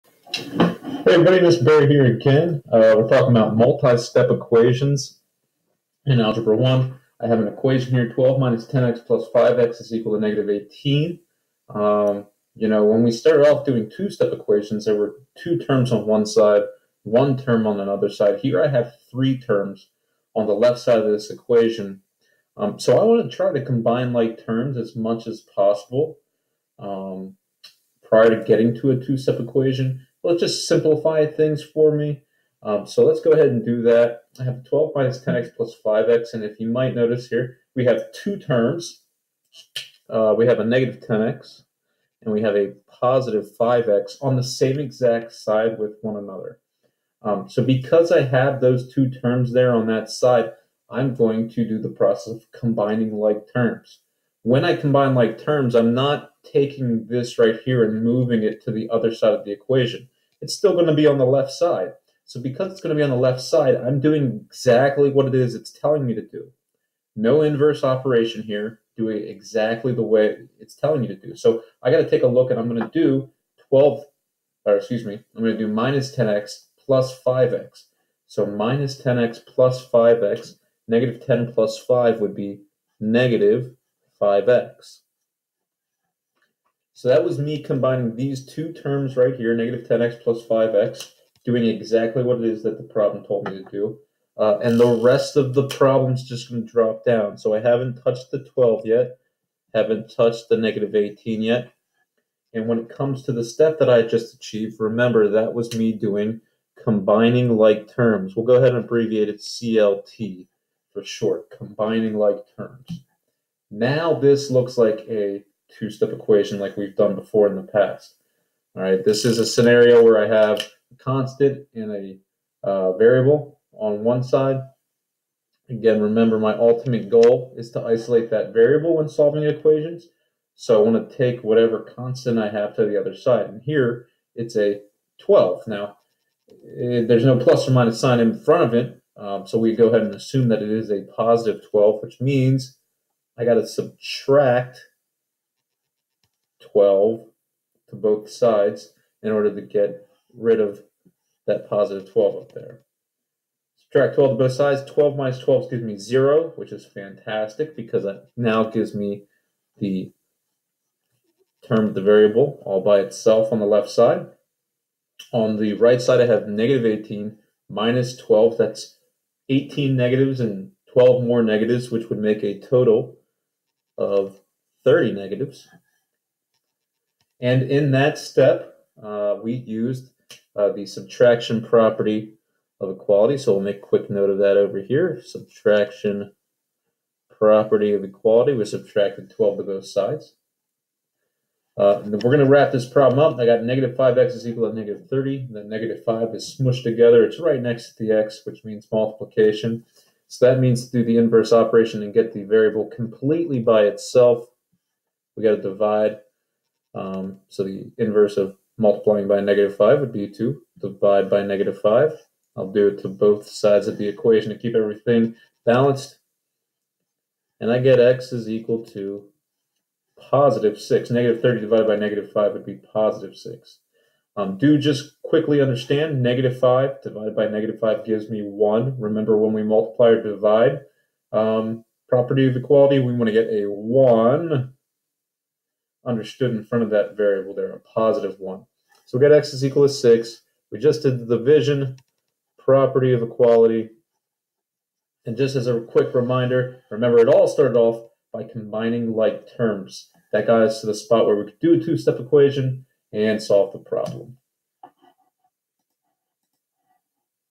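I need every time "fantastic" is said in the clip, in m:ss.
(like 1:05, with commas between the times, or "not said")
2:36.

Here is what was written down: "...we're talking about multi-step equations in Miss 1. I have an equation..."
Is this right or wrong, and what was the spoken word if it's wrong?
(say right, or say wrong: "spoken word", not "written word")
wrong: "Algebra", not "Miss".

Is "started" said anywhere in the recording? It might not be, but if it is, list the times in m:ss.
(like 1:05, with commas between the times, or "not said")
0:13, 4:07.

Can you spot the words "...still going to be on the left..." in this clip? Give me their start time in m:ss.
1:00.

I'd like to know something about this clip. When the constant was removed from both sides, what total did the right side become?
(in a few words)
-30.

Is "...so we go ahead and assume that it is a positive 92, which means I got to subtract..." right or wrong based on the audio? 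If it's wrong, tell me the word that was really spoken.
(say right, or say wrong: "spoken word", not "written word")
wrong: "12", not "92".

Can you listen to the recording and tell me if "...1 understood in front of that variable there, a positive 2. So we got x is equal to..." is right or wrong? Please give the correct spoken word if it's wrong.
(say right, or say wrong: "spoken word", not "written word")
wrong: "1", not "2".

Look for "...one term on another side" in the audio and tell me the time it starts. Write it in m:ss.
0:17.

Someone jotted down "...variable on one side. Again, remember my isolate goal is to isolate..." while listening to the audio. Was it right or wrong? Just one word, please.
wrong.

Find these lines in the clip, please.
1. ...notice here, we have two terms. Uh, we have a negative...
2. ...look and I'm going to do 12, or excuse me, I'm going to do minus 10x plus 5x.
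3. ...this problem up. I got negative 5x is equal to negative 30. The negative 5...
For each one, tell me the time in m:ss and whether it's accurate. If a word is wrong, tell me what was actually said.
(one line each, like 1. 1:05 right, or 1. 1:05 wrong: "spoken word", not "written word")
1. 0:36 right
2. 1:12 right
3. 3:12 right.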